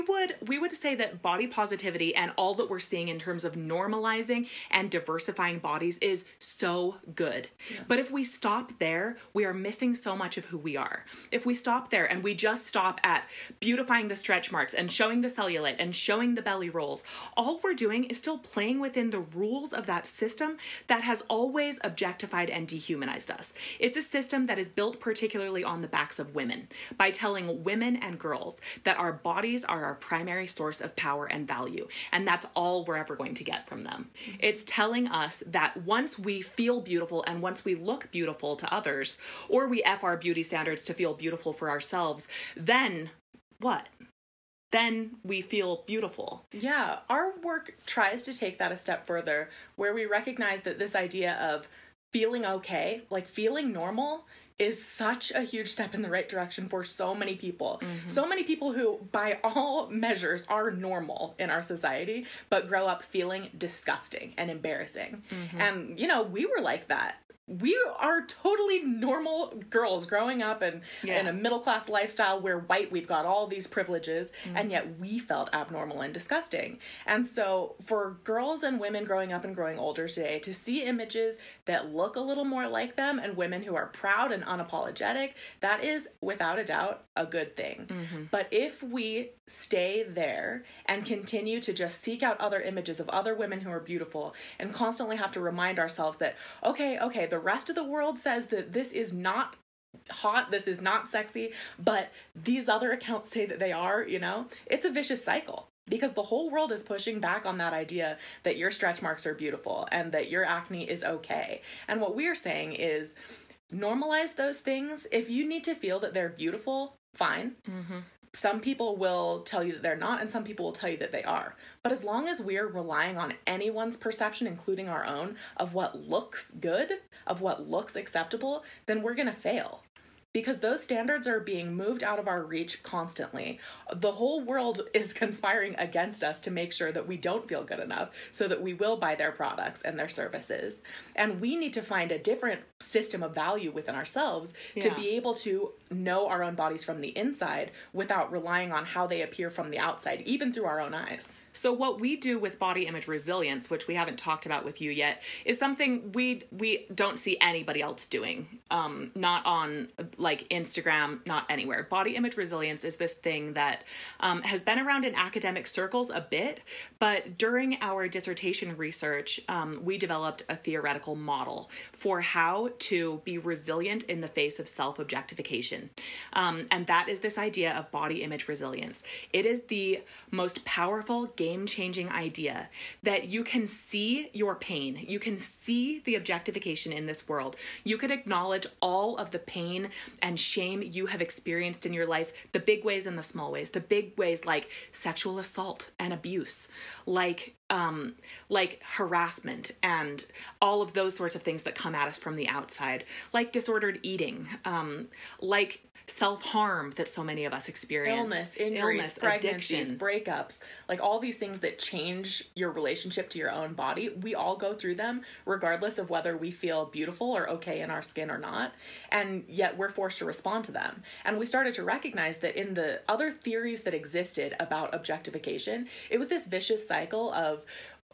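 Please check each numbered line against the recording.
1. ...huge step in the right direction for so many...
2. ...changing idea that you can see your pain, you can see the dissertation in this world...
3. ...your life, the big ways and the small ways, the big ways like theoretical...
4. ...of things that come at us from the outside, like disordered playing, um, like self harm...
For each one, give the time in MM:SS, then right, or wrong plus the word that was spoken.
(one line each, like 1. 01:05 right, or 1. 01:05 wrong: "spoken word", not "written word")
1. 00:55 right
2. 03:01 wrong: "objectification", not "dissertation"
3. 03:11 wrong: "sexual", not "theoretical"
4. 03:21 wrong: "eating", not "playing".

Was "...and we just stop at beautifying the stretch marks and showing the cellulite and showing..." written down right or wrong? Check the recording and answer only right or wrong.
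right.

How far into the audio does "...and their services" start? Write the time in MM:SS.
02:19.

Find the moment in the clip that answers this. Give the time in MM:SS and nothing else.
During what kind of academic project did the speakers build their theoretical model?
02:48.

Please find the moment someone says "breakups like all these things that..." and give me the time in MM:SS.
03:30.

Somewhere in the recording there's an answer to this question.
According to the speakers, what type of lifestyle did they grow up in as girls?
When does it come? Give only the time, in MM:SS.
01:11.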